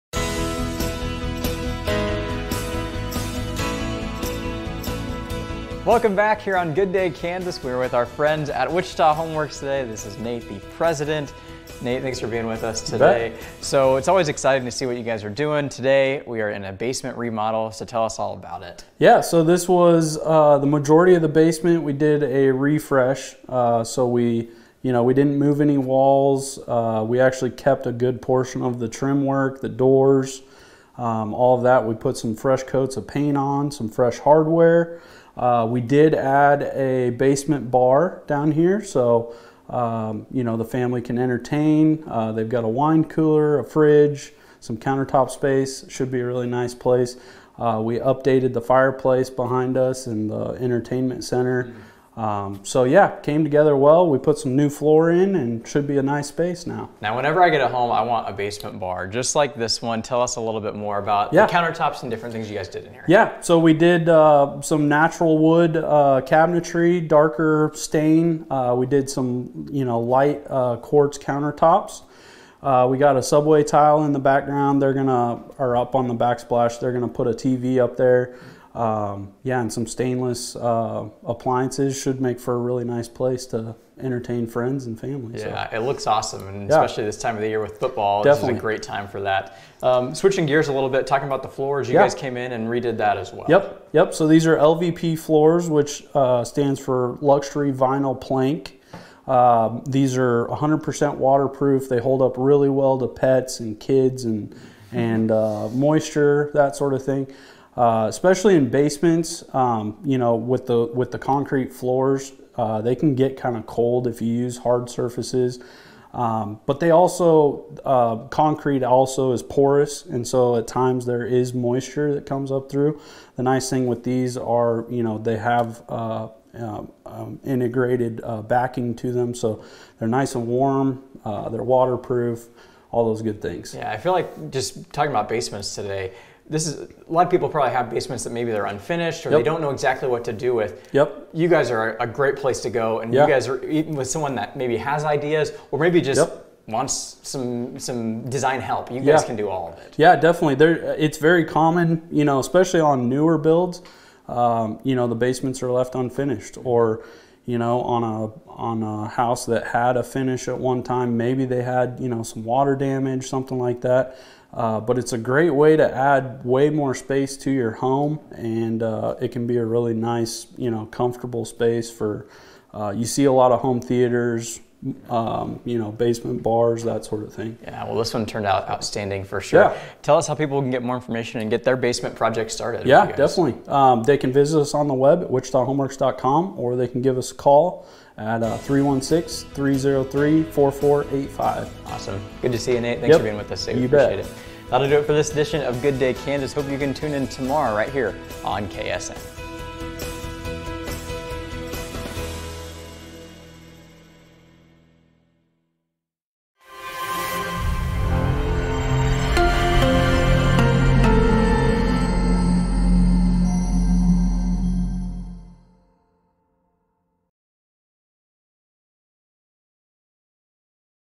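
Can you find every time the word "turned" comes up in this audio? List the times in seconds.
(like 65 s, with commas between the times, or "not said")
178 s.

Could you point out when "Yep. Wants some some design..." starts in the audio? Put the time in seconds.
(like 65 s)
146 s.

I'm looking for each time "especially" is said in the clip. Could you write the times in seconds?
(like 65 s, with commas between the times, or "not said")
86 s, 108 s, 152 s.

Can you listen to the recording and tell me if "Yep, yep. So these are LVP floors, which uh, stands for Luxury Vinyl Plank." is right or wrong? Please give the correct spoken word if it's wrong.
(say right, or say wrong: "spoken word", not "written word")
right.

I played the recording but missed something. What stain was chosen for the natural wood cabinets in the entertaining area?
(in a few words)
Darker stain.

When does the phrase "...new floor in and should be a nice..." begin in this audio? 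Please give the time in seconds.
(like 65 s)
54 s.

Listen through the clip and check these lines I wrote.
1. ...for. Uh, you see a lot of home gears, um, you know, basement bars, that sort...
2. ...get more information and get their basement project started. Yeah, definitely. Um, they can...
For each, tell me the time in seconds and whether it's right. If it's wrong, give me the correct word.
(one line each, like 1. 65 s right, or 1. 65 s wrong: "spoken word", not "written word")
1. 171 s wrong: "theaters", not "gears"
2. 180 s right.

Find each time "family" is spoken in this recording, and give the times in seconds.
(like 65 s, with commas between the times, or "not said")
40 s, 84 s.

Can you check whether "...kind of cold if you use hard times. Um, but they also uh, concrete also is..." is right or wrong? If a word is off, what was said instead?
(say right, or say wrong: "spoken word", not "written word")
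wrong: "surfaces", not "times".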